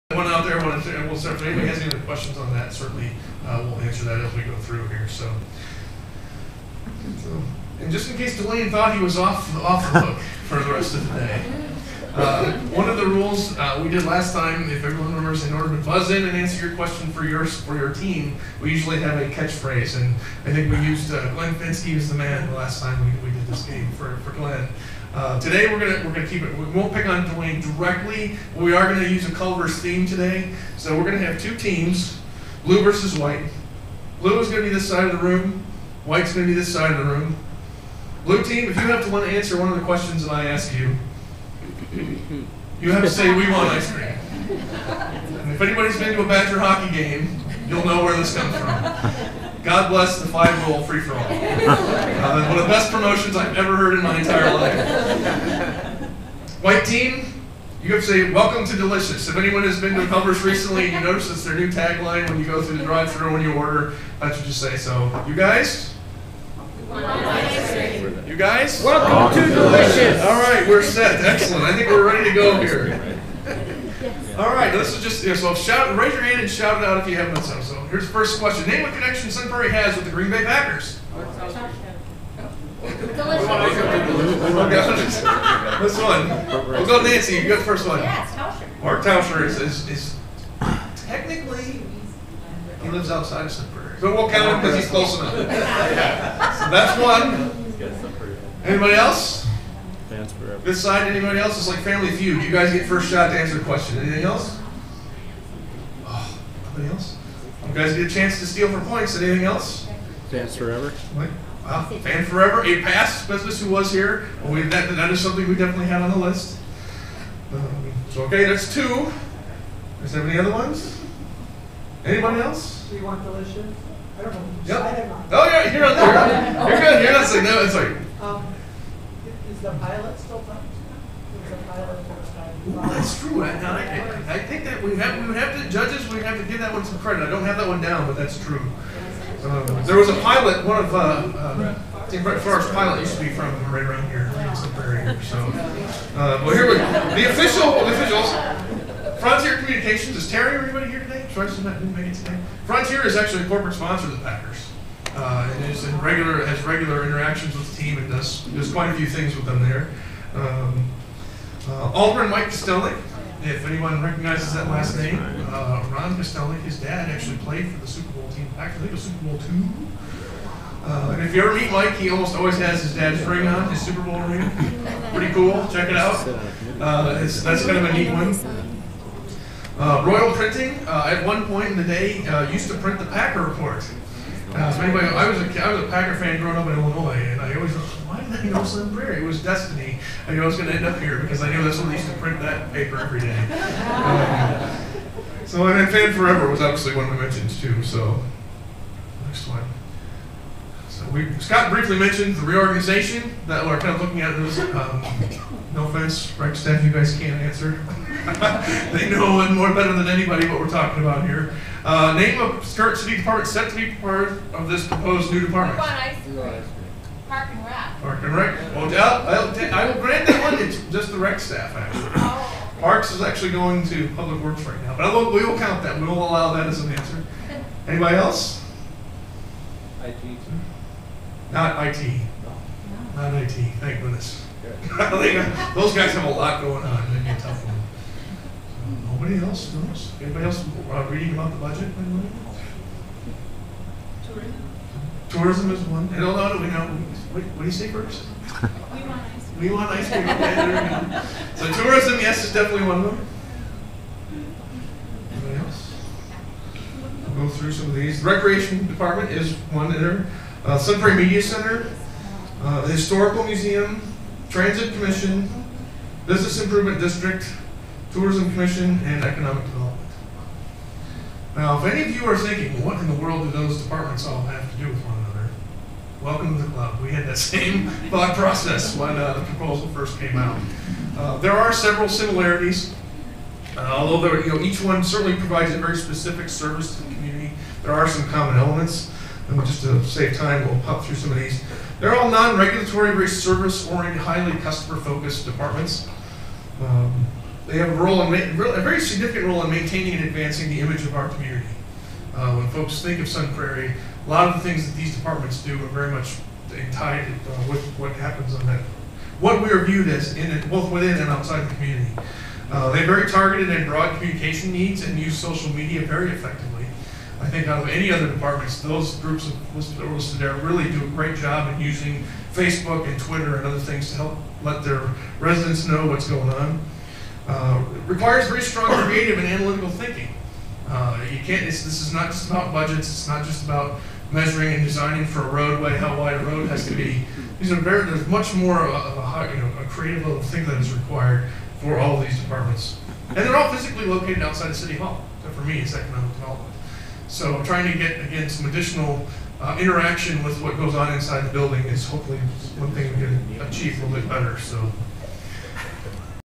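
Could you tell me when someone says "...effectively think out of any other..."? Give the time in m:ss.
5:16.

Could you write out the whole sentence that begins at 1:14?
All right, this is just so shout.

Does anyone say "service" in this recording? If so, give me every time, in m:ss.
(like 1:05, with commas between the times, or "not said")
4:46, 4:53.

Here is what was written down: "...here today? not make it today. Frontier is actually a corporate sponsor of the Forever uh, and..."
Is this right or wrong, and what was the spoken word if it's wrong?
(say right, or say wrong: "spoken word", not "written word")
wrong: "Packers", not "Forever".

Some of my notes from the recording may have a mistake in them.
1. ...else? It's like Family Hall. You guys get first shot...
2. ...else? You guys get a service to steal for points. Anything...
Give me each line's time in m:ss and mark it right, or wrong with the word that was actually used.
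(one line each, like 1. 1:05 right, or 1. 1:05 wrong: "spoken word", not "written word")
1. 1:41 wrong: "Feud", not "Hall"
2. 1:46 wrong: "chance", not "service".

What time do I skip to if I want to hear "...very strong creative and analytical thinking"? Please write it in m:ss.
5:28.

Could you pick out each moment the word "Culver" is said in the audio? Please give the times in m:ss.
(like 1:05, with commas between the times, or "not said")
0:29, 1:00.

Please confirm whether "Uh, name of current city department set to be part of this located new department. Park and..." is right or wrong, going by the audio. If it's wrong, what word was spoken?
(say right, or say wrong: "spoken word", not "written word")
wrong: "proposed", not "located".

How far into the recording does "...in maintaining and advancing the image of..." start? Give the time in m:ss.
4:59.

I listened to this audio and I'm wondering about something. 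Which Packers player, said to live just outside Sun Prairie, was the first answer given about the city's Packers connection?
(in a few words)
Mark Tauscher.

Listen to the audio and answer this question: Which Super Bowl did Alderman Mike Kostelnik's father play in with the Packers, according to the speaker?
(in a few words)
Super Bowl 2.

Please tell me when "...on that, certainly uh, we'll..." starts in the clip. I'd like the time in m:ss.
0:02.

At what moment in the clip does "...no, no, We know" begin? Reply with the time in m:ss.
4:06.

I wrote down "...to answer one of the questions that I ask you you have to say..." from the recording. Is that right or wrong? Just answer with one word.
right.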